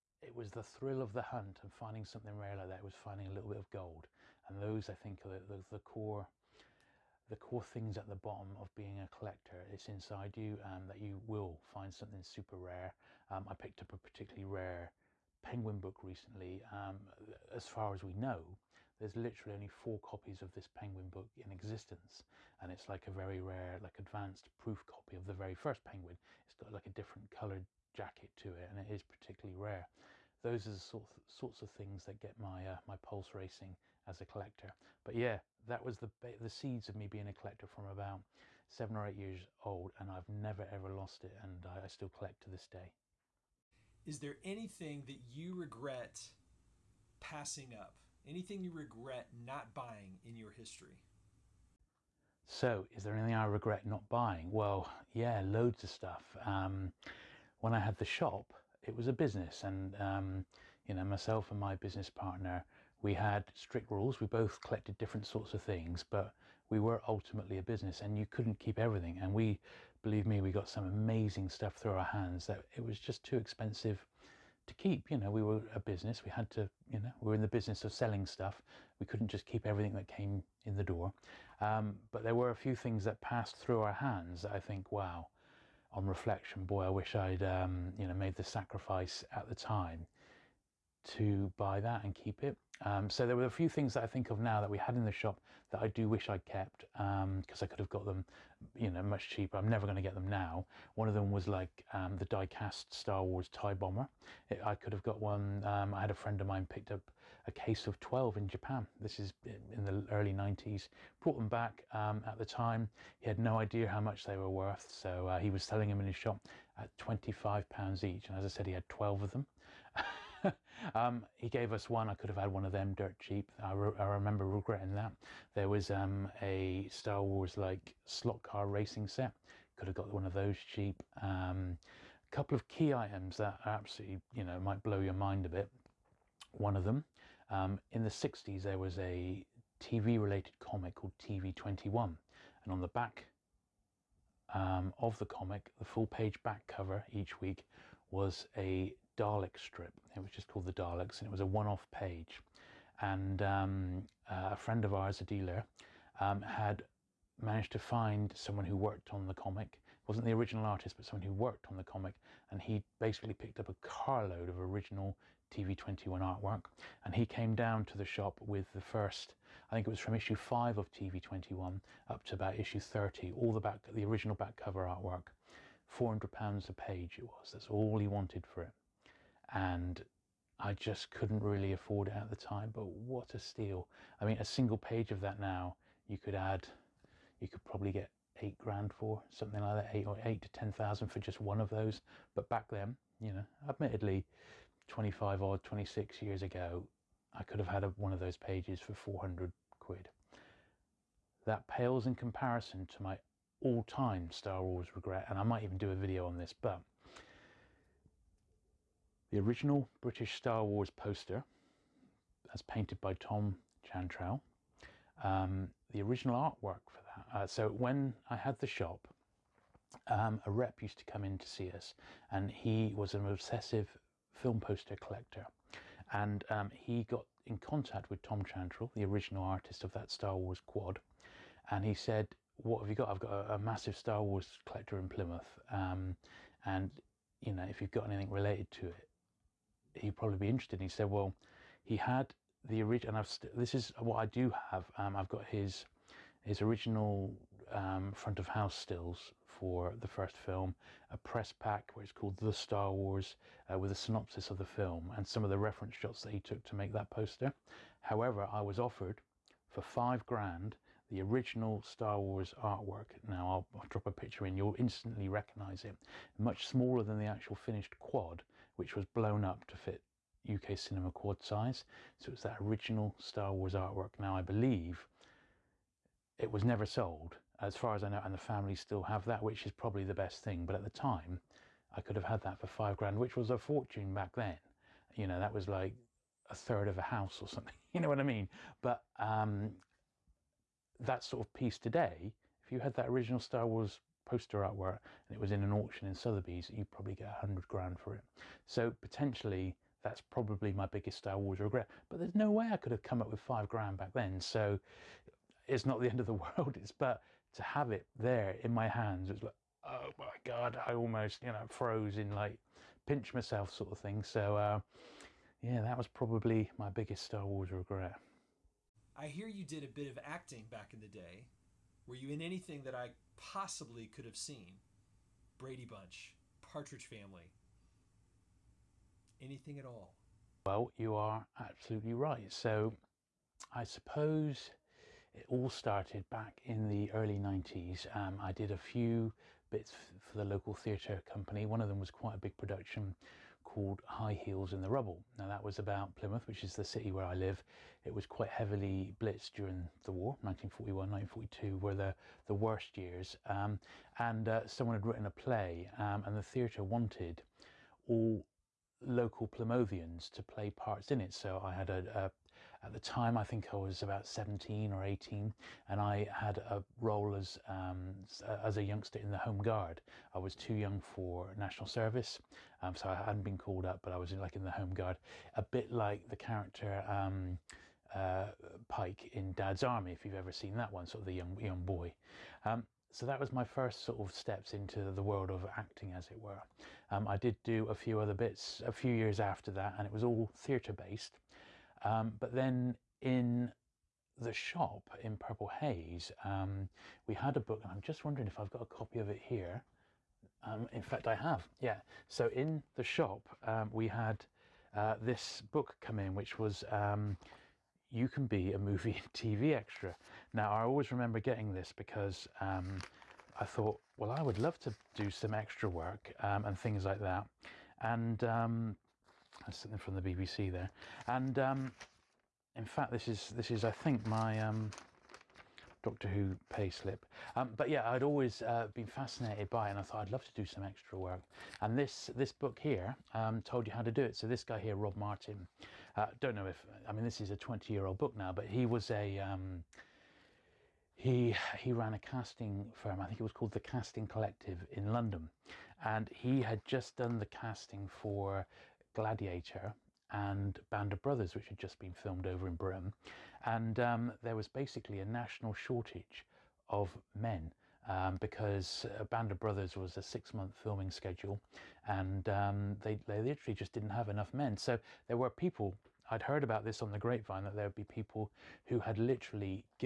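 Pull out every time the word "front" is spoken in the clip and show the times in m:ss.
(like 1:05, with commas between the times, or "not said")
4:08.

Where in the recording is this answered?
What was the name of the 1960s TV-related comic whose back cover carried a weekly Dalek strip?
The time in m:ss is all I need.
2:21.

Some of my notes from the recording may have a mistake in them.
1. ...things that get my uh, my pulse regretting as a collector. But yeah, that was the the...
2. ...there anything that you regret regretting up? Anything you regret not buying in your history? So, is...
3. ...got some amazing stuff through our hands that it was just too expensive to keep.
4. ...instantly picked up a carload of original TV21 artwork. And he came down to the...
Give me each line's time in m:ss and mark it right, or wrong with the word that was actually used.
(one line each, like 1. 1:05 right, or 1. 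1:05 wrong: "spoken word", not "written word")
1. 0:31 wrong: "racing", not "regretting"
2. 0:44 wrong: "passing", not "regretting"
3. 1:10 right
4. 2:42 wrong: "basically", not "instantly".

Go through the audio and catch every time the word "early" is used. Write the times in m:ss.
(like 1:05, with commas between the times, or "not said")
1:50, 5:37.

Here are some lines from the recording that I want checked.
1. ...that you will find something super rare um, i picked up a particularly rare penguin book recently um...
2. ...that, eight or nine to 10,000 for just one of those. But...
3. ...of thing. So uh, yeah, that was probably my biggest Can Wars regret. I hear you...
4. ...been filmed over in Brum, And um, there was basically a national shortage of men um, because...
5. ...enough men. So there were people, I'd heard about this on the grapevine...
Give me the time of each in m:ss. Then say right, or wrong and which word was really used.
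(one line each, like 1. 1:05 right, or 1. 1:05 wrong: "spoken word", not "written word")
1. 0:10 right
2. 3:09 wrong: "eight", not "nine"
3. 5:13 wrong: "Star", not "Can"
4. 7:31 right
5. 7:44 right.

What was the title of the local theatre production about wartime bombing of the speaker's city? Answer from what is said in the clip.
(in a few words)
High Heels in the Rubble.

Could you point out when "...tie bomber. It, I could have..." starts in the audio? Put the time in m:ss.
1:43.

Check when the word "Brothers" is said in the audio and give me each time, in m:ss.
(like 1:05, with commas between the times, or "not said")
7:31, 7:39.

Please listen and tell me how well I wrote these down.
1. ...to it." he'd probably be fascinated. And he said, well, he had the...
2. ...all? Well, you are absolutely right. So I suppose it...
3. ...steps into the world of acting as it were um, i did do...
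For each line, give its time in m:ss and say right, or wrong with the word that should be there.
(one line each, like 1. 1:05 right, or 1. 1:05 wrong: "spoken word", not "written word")
1. 3:58 wrong: "interested", not "fascinated"
2. 5:29 right
3. 6:24 right.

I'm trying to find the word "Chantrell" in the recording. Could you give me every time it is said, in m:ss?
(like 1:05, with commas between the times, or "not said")
3:33, 3:48.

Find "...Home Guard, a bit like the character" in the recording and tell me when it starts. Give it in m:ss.
6:14.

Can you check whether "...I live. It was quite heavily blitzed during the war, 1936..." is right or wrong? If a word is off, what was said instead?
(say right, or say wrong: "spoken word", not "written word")
wrong: "1941", not "1936".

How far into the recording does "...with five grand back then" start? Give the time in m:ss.
5:03.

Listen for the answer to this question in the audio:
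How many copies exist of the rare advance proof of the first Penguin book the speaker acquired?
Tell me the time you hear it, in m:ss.
0:19.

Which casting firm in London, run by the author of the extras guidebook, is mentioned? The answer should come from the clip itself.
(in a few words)
Casting Collective.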